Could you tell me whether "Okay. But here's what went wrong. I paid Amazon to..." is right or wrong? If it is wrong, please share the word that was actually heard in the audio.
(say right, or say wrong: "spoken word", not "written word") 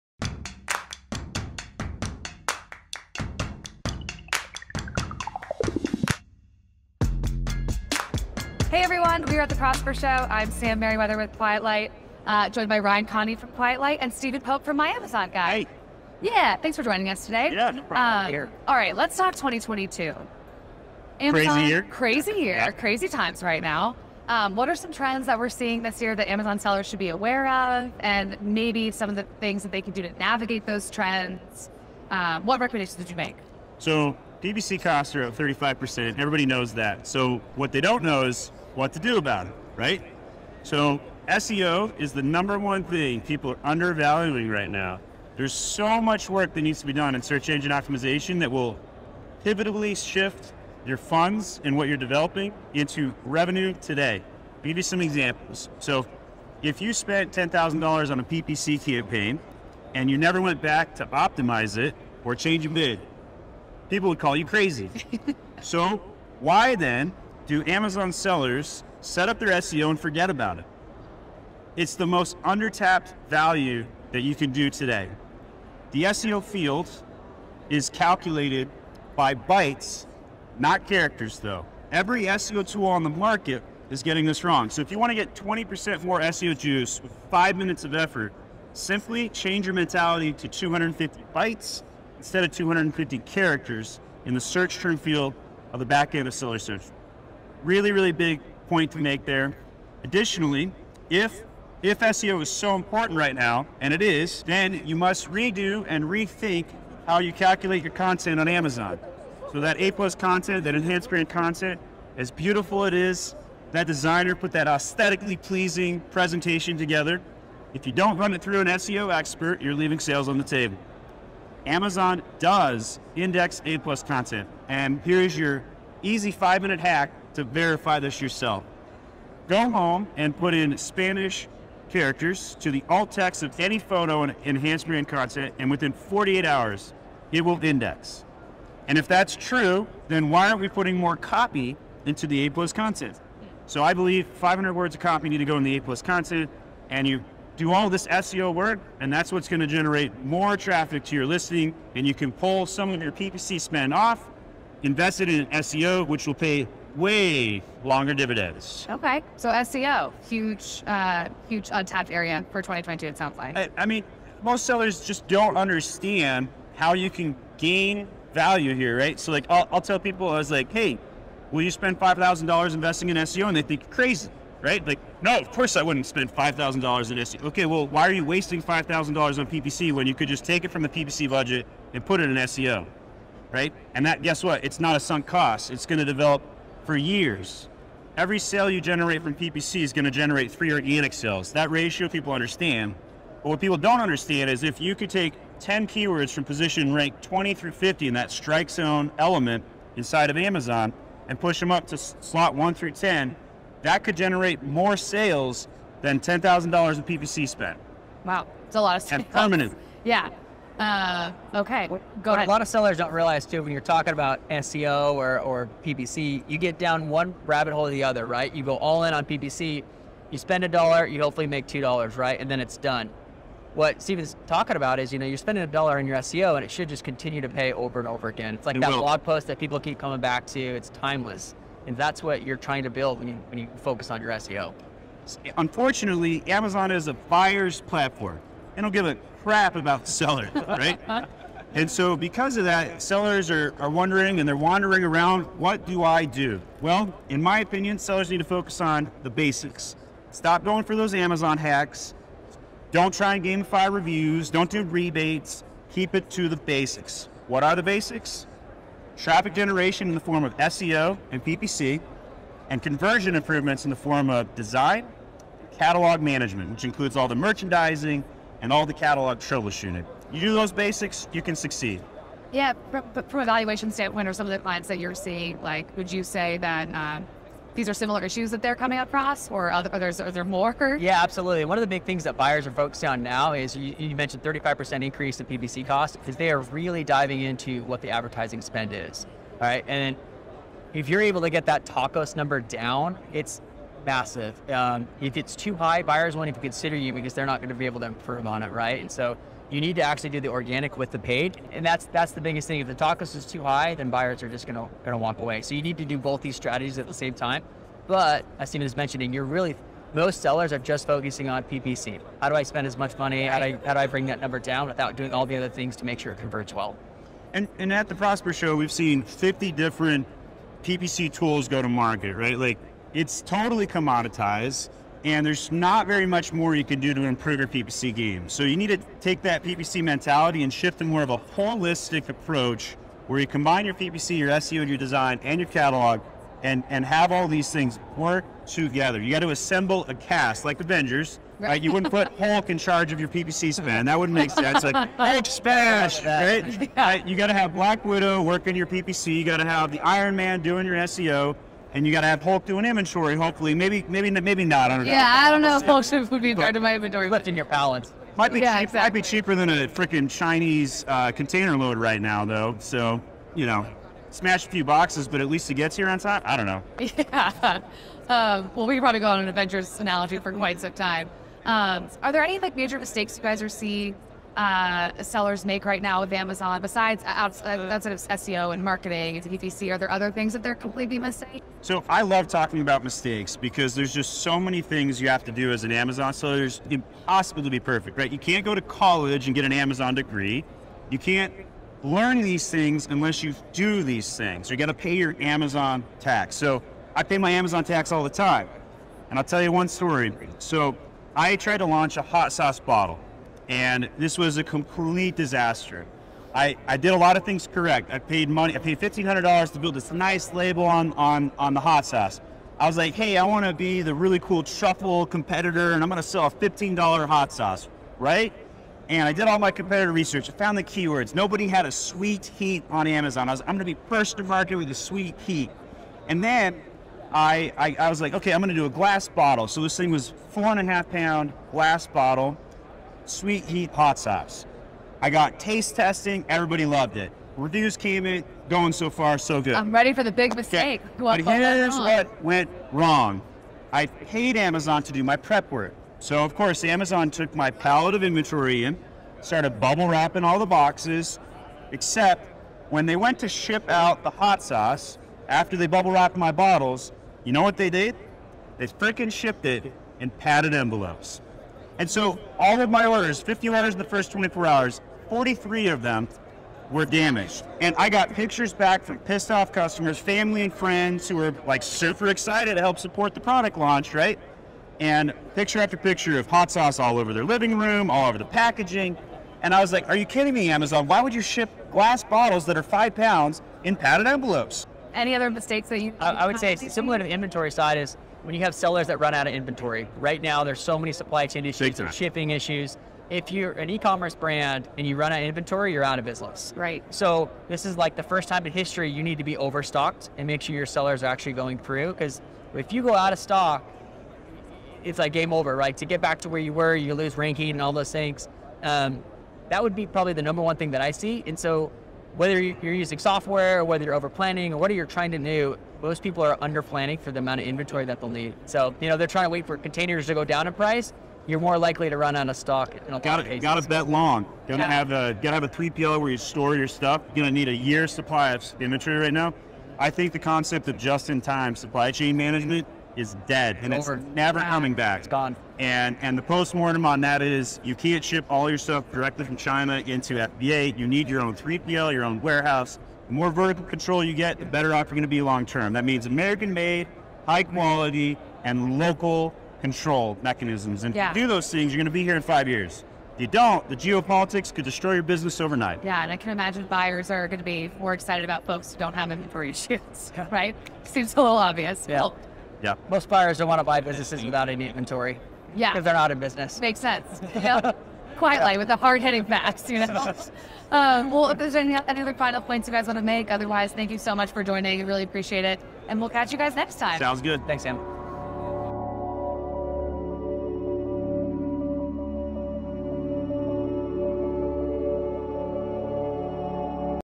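right.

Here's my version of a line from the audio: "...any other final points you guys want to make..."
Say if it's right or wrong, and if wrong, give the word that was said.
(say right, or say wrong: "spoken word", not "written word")
right.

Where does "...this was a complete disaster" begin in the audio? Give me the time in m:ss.
6:44.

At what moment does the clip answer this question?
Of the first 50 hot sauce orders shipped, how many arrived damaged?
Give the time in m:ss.
7:45.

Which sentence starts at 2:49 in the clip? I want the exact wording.
So like, I'll, I'll tell people, I was like, hey, will you spend five thousand dollars investing in SEO?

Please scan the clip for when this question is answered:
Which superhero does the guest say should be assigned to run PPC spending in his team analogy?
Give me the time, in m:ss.
5:47.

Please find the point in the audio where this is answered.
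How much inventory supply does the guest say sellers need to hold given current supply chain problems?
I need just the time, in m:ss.
8:47.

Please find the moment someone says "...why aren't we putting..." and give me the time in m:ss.
2:20.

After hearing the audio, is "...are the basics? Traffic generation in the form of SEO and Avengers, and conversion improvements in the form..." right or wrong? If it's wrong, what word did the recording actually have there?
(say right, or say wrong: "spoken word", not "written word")
wrong: "PPC", not "Avengers".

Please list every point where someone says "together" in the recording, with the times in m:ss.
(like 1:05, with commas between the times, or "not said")
1:56, 5:38.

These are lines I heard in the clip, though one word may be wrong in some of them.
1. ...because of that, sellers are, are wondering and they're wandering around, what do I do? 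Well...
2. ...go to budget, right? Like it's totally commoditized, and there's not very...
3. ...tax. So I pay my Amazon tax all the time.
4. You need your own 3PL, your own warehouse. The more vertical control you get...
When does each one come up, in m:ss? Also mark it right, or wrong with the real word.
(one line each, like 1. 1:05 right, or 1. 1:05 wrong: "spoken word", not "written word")
1. 4:02 right
2. 5:21 wrong: "market", not "budget"
3. 6:36 right
4. 9:00 right.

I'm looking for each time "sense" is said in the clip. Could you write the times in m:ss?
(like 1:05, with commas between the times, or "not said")
5:44, 9:27.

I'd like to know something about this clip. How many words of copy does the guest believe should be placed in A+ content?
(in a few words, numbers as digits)
500.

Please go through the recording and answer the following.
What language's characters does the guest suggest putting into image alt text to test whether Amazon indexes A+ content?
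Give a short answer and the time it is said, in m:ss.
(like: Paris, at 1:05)
Spanish, at 2:10.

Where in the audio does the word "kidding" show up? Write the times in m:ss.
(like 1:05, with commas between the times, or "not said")
8:00.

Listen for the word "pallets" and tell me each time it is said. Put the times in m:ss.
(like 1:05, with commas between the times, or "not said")
5:57, 7:27.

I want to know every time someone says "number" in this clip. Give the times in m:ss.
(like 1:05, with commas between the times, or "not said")
0:42, 4:52, 5:14, 8:30.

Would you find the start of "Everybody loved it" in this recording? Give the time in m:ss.
7:16.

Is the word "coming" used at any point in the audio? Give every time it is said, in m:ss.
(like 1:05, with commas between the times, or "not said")
3:49, 4:38, 8:54.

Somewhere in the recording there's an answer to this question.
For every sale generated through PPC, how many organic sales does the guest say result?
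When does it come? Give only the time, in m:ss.
3:10.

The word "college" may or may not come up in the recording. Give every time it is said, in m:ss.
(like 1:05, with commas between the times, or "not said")
6:28.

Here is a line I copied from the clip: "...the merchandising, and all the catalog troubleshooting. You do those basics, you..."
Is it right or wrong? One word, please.
right.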